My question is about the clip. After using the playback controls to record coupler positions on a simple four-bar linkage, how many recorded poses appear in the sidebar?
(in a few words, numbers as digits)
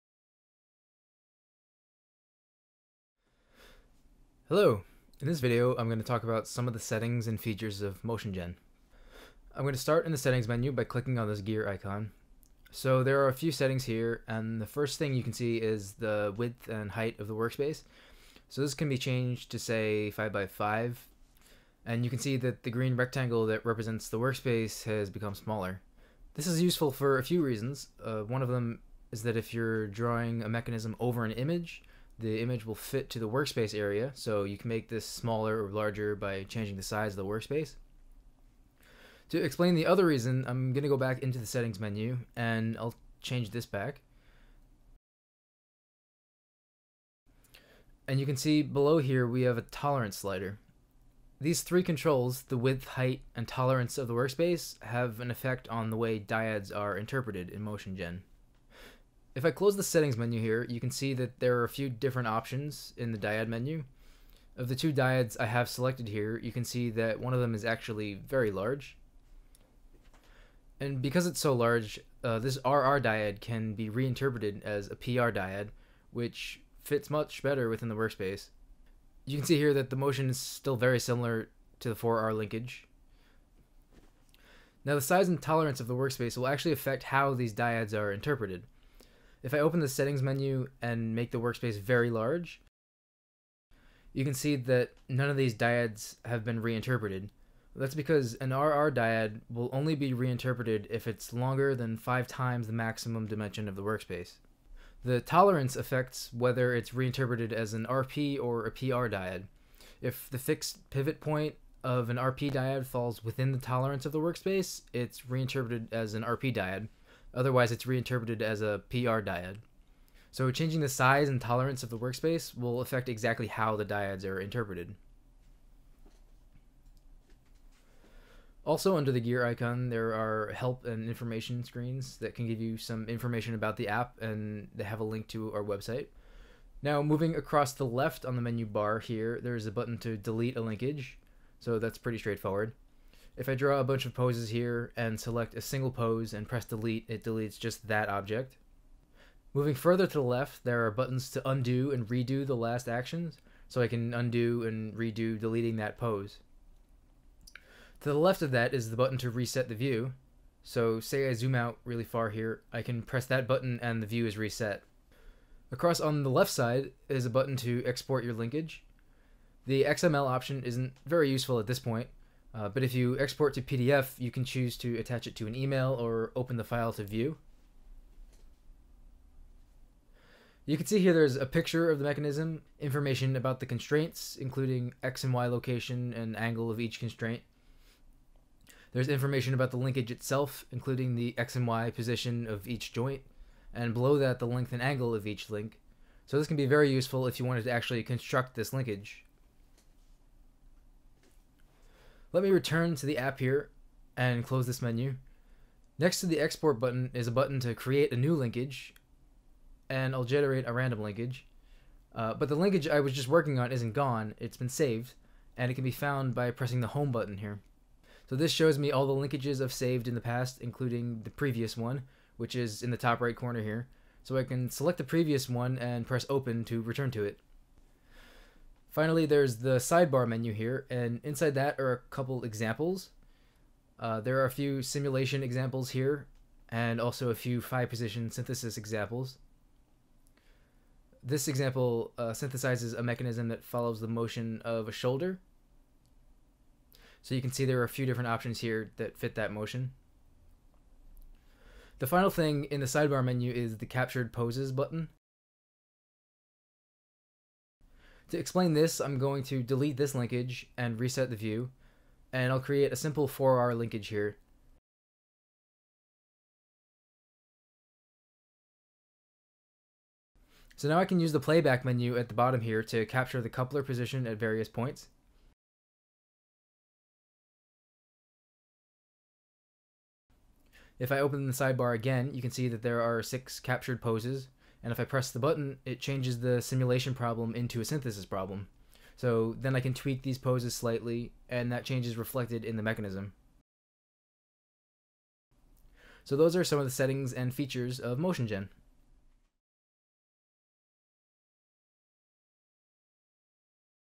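6.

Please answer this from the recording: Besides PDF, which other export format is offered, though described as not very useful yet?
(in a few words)
XML.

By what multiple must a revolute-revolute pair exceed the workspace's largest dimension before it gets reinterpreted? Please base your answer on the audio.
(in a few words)
5 times.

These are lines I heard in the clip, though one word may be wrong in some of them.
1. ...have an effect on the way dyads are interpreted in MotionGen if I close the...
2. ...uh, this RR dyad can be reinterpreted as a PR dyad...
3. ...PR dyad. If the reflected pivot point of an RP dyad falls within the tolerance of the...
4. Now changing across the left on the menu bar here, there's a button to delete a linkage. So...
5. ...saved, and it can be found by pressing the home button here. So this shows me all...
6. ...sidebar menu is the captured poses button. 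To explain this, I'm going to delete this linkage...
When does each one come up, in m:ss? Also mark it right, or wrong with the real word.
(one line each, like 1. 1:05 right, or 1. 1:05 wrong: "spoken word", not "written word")
1. 0:54 right
2. 1:12 right
3. 1:48 wrong: "fixed", not "reflected"
4. 2:16 wrong: "moving", not "changing"
5. 3:34 right
6. 4:12 right.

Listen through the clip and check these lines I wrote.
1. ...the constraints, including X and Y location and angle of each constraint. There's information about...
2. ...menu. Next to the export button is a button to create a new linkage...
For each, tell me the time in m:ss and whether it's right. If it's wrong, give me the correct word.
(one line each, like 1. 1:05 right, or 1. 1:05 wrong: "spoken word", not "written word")
1. 3:03 right
2. 3:24 right.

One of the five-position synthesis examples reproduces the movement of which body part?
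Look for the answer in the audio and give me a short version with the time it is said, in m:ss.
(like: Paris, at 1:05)
Shoulder, at 4:04.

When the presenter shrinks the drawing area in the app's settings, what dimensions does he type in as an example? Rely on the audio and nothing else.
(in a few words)
5x5.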